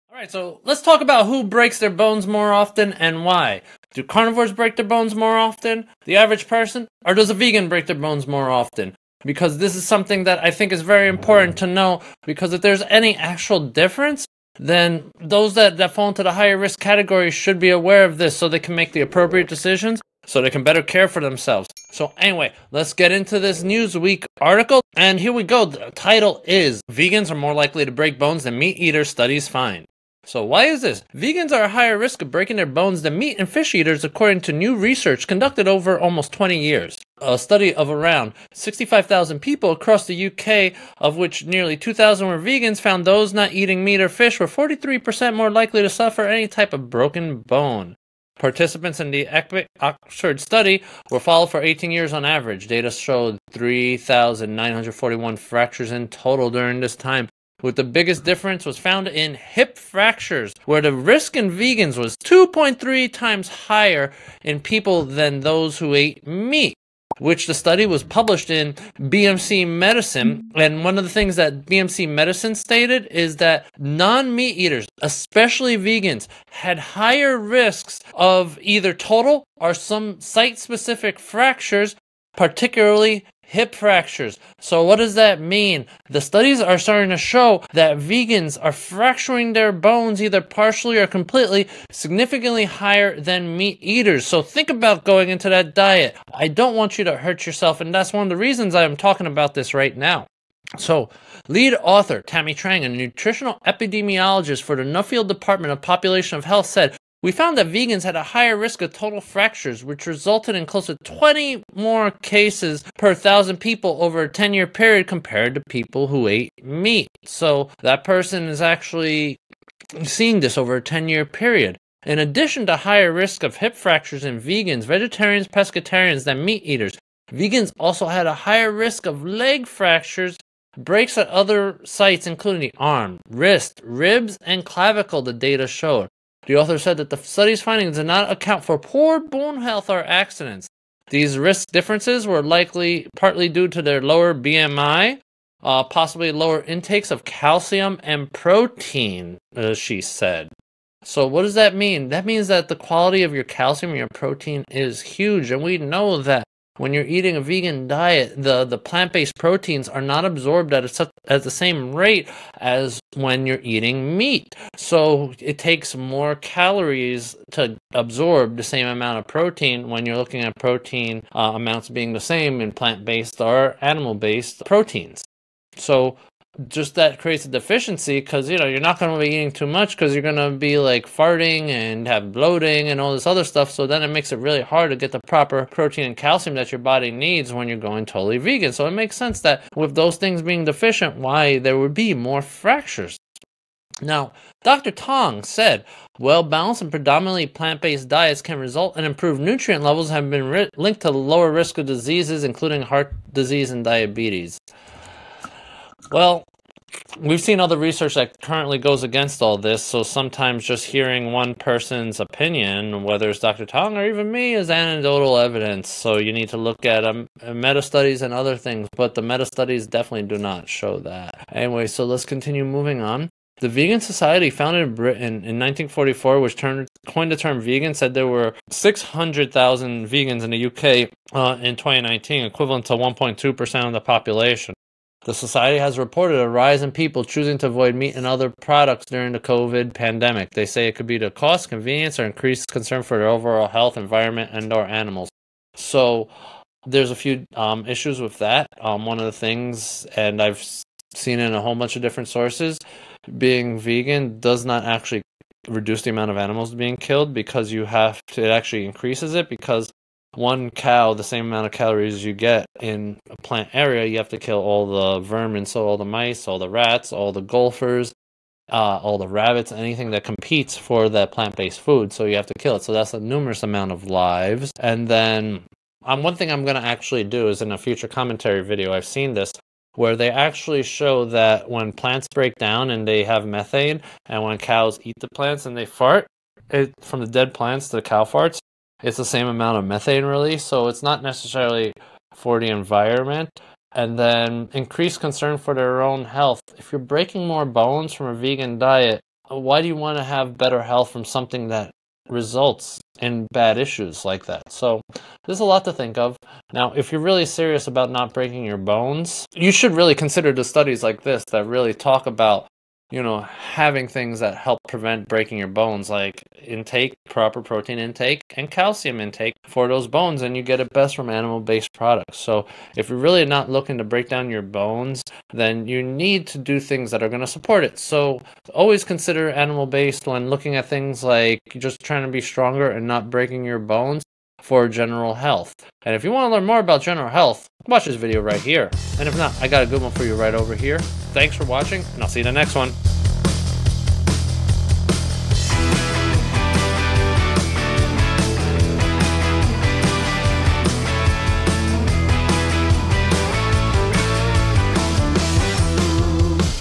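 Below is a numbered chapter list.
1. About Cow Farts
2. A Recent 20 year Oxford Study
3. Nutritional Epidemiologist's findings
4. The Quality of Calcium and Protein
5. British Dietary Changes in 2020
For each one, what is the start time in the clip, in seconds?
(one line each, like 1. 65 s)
1. 281 s
2. 35 s
3. 104 s
4. 150 s
5. 222 s.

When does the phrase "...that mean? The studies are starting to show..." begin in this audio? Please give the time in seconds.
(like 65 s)
85 s.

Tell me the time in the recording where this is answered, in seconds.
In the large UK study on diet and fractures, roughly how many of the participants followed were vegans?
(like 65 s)
41 s.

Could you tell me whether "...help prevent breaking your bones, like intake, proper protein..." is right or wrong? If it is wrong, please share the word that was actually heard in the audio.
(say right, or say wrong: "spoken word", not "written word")
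right.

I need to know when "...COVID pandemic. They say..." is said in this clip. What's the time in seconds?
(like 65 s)
239 s.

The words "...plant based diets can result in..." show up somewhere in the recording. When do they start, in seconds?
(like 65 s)
197 s.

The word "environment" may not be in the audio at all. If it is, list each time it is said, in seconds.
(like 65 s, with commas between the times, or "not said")
243 s, 292 s.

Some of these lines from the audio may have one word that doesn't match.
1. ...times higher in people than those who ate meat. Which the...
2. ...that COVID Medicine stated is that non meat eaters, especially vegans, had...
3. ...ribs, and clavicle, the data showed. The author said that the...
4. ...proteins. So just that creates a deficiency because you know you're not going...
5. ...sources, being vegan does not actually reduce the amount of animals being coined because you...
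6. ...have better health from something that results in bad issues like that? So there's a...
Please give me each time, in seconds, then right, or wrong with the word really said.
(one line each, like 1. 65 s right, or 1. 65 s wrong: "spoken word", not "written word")
1. 63 s right
2. 71 s wrong: "BMC", not "COVID"
3. 133 s right
4. 174 s right
5. 252 s wrong: "killed", not "coined"
6. 300 s right.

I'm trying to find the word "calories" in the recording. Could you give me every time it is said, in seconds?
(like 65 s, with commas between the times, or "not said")
166 s, 261 s.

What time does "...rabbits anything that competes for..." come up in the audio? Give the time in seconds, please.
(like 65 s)
269 s.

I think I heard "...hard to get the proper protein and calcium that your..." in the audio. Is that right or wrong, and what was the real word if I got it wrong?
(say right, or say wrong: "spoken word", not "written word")
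right.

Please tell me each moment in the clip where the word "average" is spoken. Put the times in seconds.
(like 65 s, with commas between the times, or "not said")
6 s, 52 s.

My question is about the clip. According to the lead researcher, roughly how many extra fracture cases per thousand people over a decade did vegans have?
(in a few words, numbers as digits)
20.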